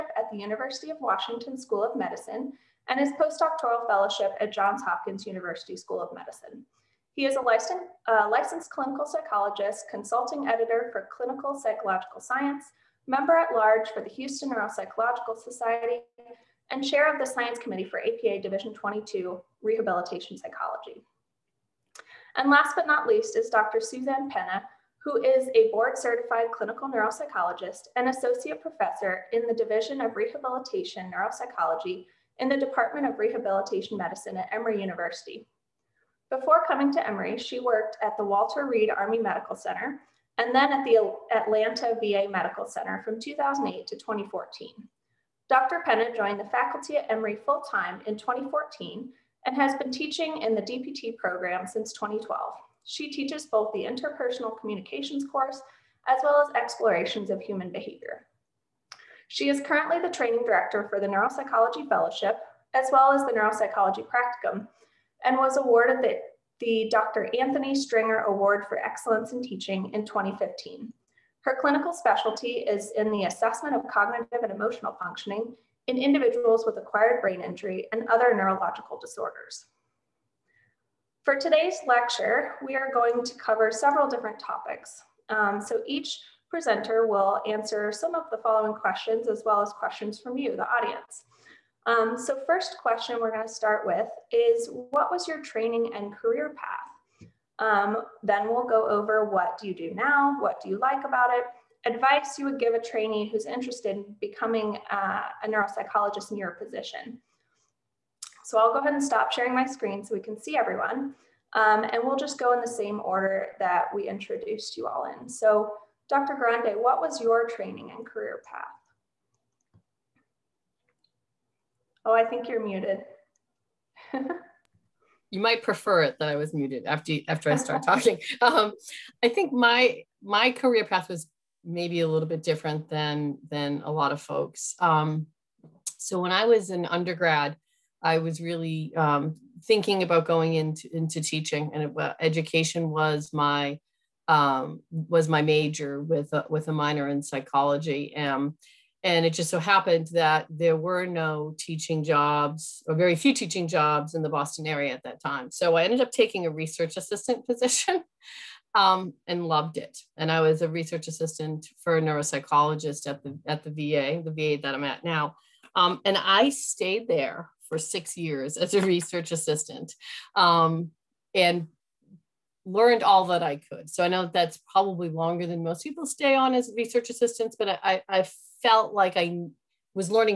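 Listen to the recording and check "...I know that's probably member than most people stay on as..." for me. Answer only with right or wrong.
wrong.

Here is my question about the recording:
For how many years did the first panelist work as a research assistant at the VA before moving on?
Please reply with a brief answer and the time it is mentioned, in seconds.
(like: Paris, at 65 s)
6, at 167 s.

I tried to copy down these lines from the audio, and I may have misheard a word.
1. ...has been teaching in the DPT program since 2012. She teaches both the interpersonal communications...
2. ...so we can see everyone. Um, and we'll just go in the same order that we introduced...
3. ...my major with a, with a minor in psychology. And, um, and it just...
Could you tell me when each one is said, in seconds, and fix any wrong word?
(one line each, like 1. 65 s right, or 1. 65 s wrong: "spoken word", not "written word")
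1. 49 s right
2. 110 s right
3. 145 s right.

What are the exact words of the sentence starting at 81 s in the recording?
For today's lecture, we are going to cover several different topics.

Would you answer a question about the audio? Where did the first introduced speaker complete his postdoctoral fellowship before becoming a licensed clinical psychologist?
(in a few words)
Johns Hopkins University School of Medicine.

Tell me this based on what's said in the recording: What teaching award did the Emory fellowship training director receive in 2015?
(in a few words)
Dr. Anthony Stringer Award.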